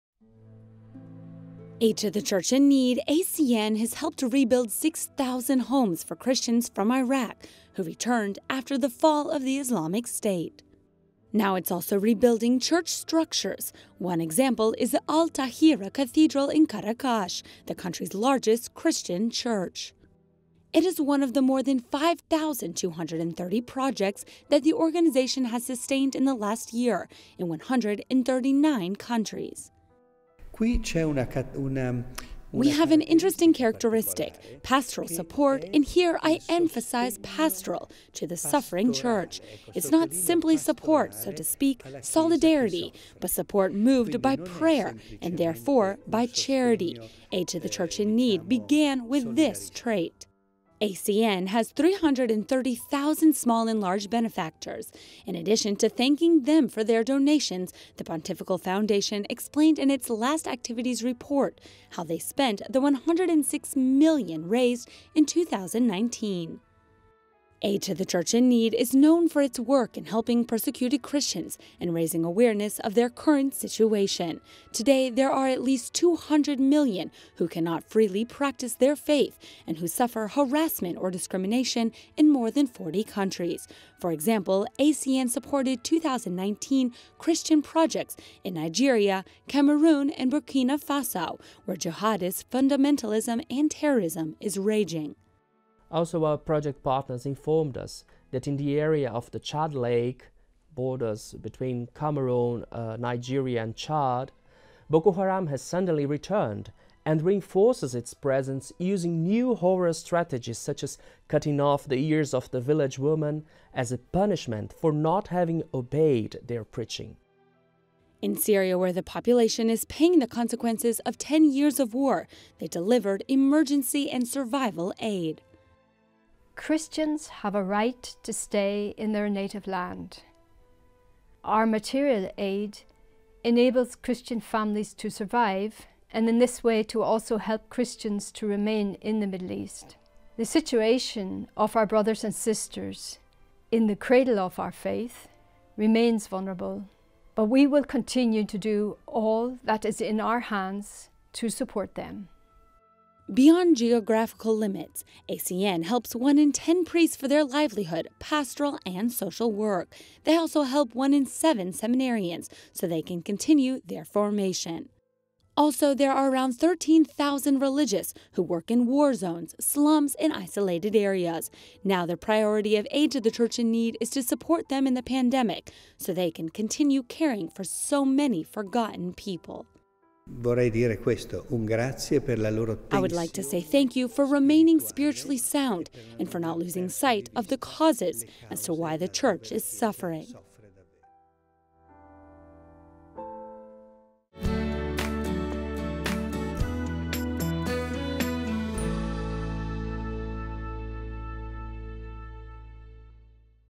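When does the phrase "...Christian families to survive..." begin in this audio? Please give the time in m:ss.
2:13.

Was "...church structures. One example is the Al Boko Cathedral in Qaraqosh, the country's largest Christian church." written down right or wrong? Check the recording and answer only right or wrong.
wrong.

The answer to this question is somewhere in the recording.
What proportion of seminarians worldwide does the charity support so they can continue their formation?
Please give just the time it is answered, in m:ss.
2:40.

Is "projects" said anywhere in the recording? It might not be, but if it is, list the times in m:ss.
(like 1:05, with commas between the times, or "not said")
0:23, 1:27, 1:36.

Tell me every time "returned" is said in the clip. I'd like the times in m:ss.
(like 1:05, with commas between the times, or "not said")
0:07, 1:46.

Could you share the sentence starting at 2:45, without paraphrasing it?
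Also, there are around 13,000 religious who work in war zones, slums, and isolated areas.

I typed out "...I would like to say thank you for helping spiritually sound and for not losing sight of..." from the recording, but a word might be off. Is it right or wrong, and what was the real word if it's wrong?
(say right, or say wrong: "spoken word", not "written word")
wrong: "remaining", not "helping".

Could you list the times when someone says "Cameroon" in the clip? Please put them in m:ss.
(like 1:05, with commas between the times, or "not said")
1:29, 1:41.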